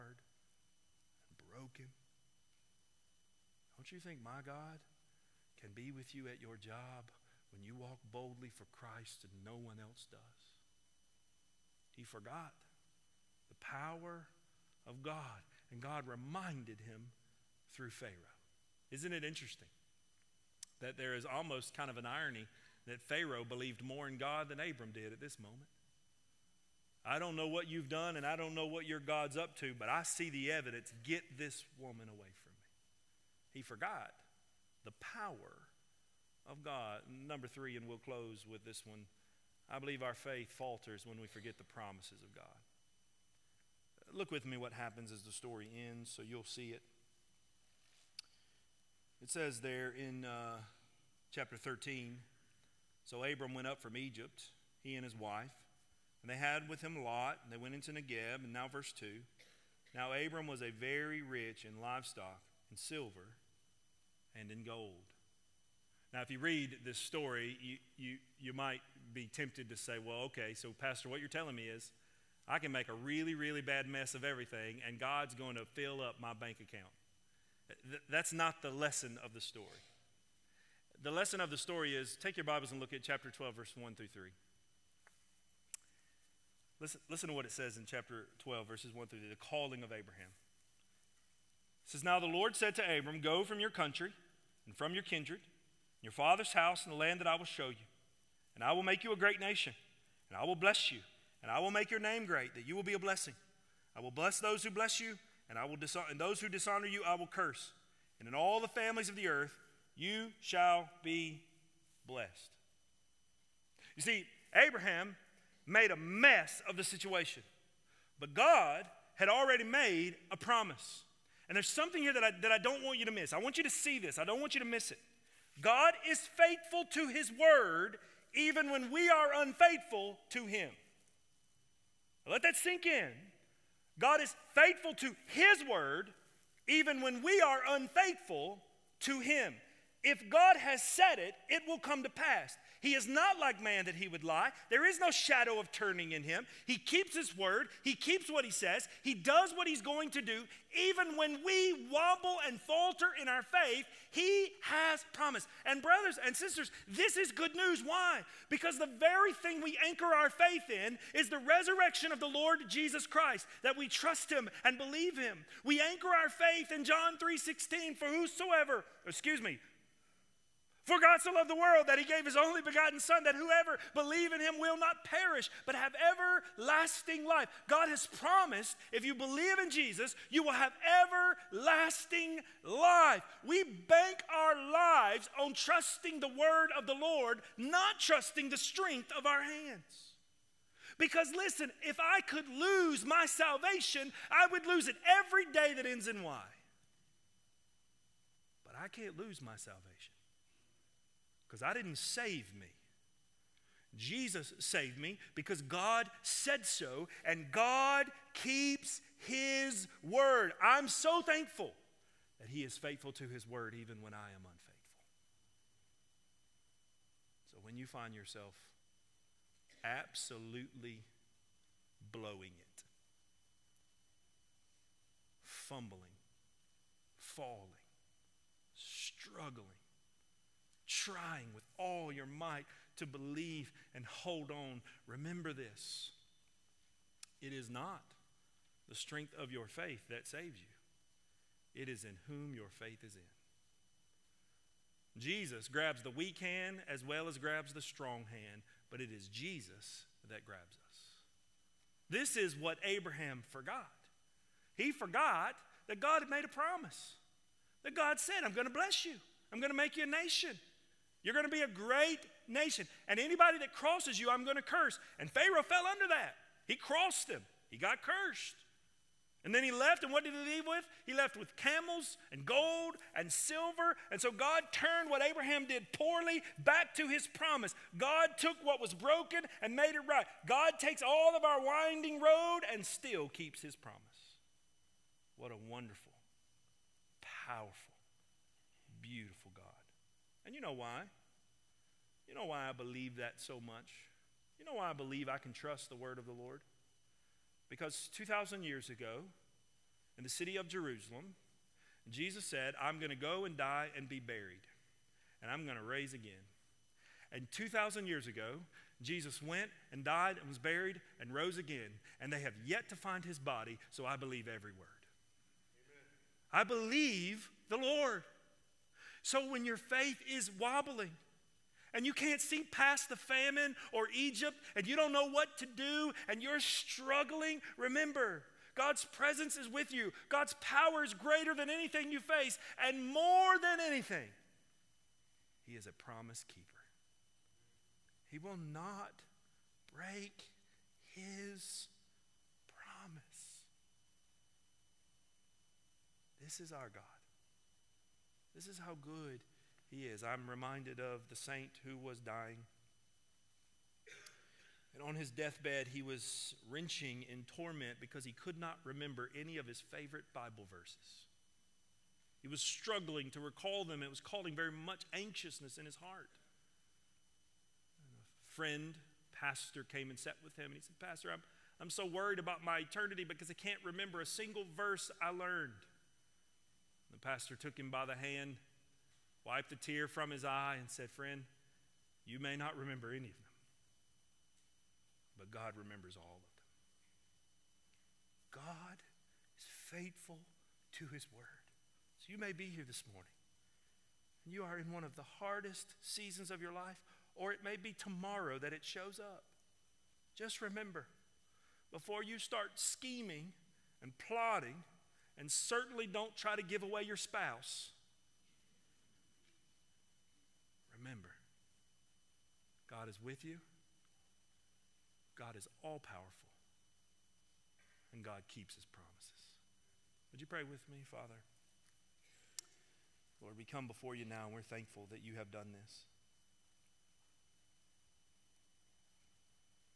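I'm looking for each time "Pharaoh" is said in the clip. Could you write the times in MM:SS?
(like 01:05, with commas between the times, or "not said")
00:17, 00:23, 04:25.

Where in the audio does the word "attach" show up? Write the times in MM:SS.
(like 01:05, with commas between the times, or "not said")
not said.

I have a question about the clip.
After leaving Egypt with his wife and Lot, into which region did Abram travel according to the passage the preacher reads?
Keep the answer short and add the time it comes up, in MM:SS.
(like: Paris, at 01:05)
Negeb, at 00:57.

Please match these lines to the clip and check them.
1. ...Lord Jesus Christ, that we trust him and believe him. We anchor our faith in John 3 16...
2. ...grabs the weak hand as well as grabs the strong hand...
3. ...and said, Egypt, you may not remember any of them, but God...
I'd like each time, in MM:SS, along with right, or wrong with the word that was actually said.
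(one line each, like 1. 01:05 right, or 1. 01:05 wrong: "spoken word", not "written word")
1. 02:42 right
2. 04:05 right
3. 06:20 wrong: "Friend", not "Egypt".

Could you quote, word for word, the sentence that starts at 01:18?
that's not the lesson of the story.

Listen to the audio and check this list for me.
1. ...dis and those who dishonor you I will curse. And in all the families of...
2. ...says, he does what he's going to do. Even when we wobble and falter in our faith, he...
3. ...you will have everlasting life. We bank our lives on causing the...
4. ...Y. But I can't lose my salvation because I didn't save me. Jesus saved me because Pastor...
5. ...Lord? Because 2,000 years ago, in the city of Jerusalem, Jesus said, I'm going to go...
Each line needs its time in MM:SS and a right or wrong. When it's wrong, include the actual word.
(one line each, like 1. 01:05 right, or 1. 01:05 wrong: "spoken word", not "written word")
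1. 01:45 right
2. 02:28 right
3. 03:00 wrong: "trusting", not "causing"
4. 03:16 wrong: "God", not "Pastor"
5. 04:56 right.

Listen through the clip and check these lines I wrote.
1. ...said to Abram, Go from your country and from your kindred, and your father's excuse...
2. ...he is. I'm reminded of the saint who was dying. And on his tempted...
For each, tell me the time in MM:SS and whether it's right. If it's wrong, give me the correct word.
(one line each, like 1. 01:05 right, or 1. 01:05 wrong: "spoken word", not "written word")
1. 01:32 wrong: "house", not "excuse"
2. 05:49 wrong: "deathbed", not "tempted".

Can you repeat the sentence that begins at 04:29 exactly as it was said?
And then he left, and what did he leave with?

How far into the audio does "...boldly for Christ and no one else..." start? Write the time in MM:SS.
00:08.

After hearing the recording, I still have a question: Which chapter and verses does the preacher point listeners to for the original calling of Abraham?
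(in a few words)
Chapter 12, verses 1-3.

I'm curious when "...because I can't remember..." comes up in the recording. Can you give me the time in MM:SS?
06:13.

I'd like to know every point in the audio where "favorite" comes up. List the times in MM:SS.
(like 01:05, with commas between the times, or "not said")
05:59.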